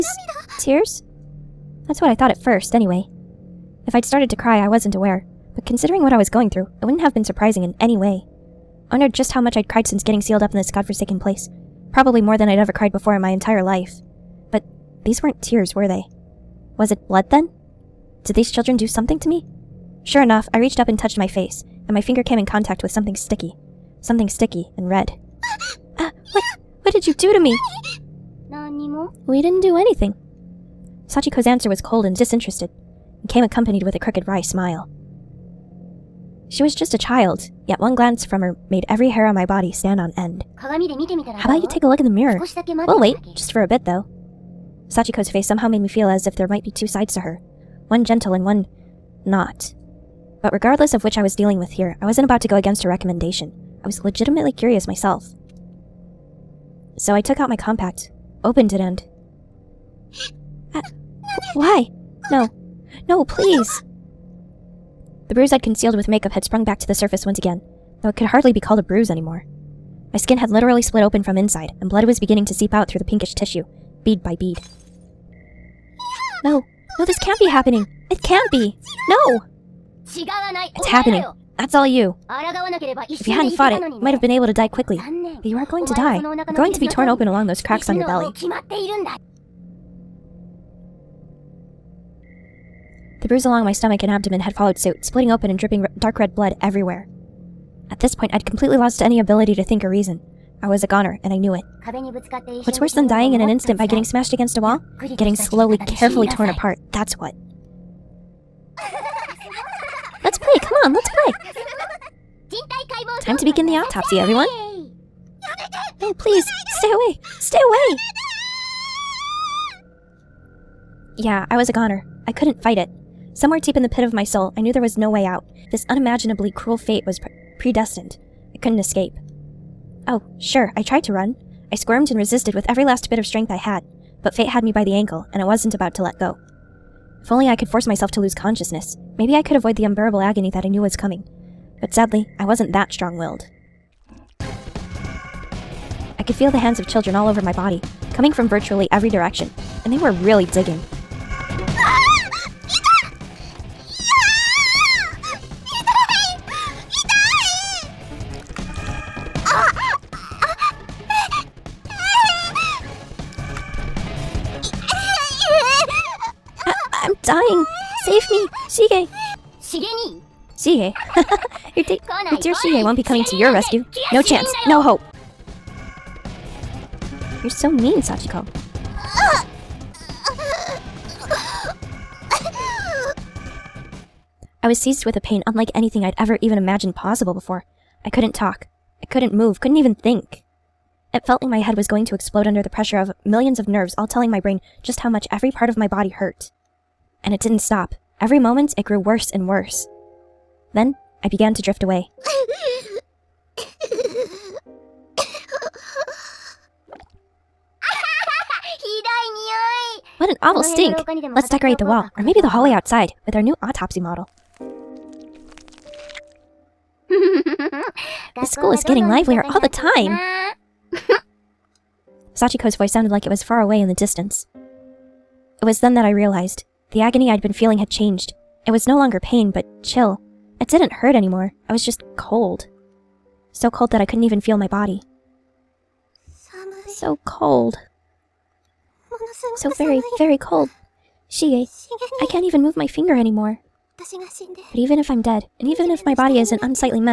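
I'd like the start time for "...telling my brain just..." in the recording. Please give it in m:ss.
3:14.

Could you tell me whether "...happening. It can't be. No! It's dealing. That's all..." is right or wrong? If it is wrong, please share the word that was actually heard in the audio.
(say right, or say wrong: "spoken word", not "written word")
wrong: "happening", not "dealing".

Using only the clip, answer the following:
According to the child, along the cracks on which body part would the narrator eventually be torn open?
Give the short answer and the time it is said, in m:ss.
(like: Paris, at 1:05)
Belly, at 1:28.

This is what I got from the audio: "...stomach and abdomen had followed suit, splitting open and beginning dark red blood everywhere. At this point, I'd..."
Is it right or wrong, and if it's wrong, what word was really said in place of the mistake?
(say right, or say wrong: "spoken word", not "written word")
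wrong: "dripping", not "beginning".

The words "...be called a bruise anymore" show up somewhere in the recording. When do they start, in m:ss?
1:08.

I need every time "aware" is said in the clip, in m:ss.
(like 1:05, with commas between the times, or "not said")
0:04.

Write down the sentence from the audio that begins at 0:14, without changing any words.
But these weren't tears, were they?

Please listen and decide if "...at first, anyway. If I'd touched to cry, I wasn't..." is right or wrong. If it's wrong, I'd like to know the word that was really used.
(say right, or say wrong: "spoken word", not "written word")
wrong: "started", not "touched".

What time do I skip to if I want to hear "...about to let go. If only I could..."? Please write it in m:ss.
2:15.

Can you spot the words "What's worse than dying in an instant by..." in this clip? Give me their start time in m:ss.
1:42.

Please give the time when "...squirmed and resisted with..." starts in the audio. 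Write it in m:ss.
2:11.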